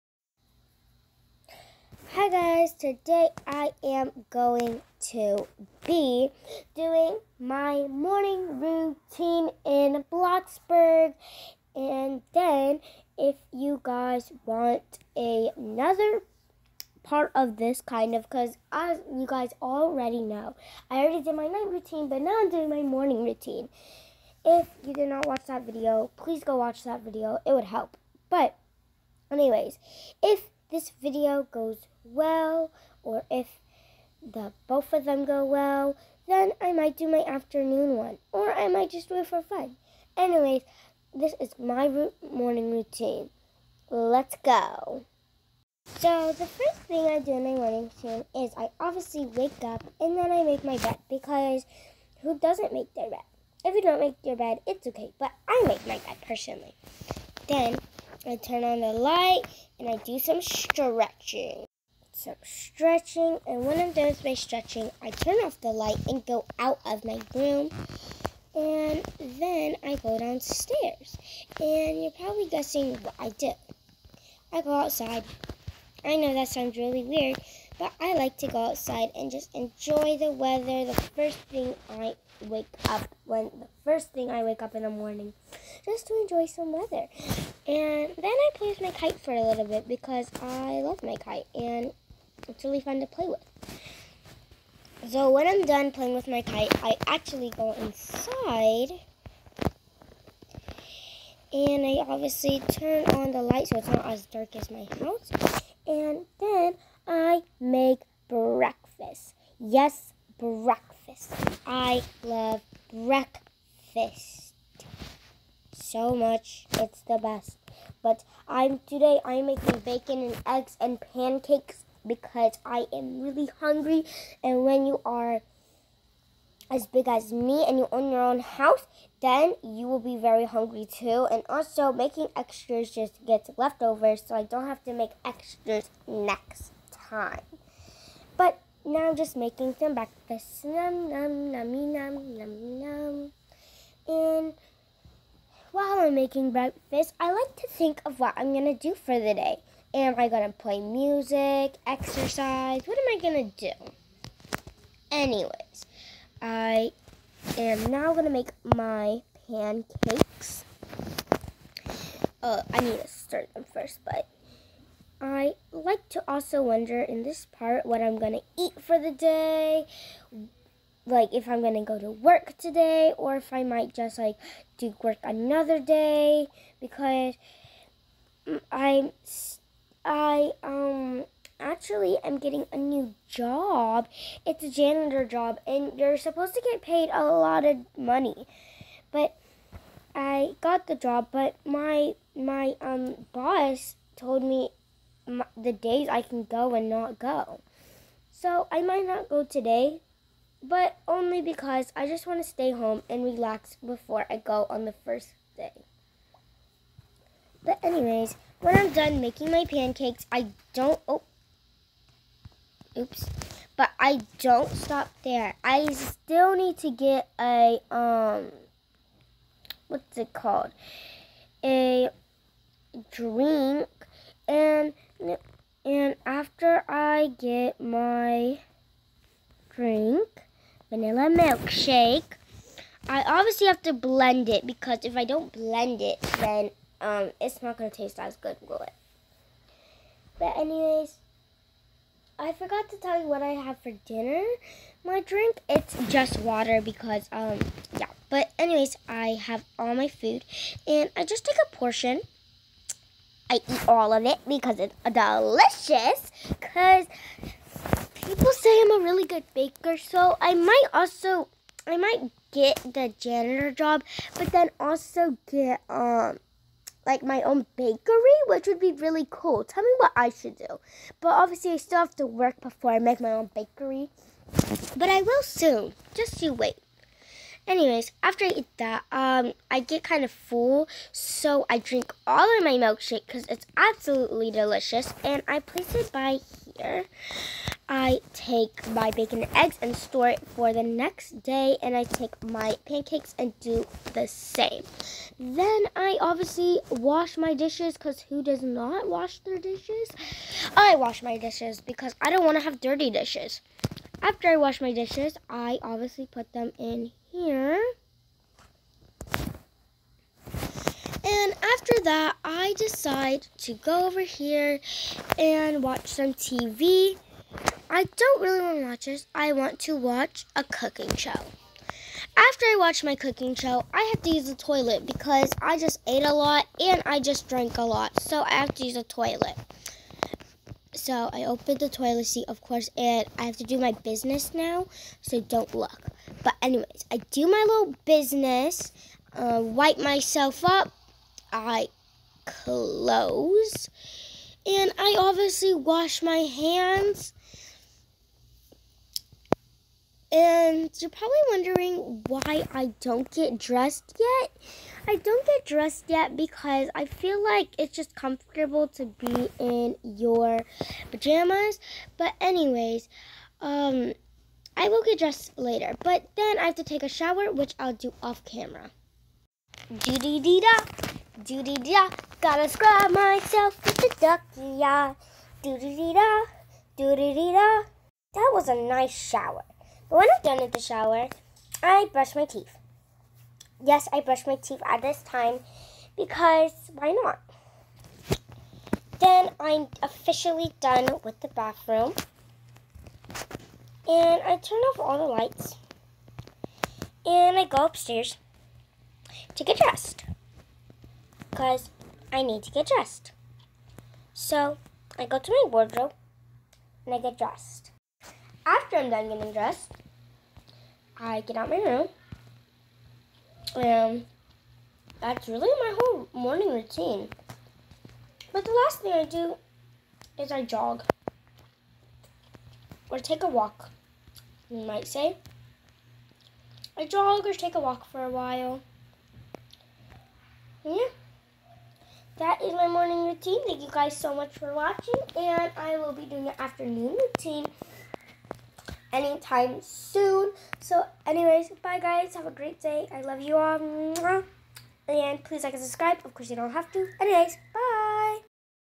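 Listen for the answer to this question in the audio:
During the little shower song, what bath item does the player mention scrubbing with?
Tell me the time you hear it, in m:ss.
6:14.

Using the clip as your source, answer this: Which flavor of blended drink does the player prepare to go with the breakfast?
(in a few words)
Vanilla milkshake.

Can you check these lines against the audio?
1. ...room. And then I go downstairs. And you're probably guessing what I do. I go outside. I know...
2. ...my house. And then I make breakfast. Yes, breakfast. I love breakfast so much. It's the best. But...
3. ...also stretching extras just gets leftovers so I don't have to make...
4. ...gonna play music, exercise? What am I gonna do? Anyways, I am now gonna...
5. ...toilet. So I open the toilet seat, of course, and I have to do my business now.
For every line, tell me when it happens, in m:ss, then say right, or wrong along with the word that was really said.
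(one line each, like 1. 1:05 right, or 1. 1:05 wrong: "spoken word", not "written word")
1. 1:07 right
2. 1:44 right
3. 2:11 wrong: "making", not "stretching"
4. 2:30 right
5. 5:29 right.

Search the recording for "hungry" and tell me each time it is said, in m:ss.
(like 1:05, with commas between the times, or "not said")
2:03, 2:10.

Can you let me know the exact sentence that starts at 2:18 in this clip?
Now I'm just making some breakfast.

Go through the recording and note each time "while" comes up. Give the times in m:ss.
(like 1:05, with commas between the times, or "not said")
2:25, 7:08.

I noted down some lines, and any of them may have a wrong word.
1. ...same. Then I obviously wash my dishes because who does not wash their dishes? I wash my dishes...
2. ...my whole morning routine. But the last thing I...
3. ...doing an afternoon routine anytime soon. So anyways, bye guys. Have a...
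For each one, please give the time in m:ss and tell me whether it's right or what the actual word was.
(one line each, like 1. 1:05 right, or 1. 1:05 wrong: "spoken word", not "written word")
1. 4:54 right
2. 6:55 right
3. 7:16 right.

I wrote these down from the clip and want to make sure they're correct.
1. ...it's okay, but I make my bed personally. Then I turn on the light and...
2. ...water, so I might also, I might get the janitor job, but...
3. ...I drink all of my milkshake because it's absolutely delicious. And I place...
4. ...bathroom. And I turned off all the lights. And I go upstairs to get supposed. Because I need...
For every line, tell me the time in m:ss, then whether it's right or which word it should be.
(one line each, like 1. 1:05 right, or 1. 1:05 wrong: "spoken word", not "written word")
1. 0:54 right
2. 4:19 wrong: "baker", not "water"
3. 4:41 right
4. 6:31 wrong: "dressed", not "supposed".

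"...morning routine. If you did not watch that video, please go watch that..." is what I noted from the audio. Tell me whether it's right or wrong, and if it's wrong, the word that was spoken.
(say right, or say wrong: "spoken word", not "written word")
right.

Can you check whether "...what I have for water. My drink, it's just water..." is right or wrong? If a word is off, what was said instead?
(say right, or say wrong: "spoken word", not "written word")
wrong: "dinner", not "water".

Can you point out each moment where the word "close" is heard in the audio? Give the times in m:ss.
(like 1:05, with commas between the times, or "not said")
5:42.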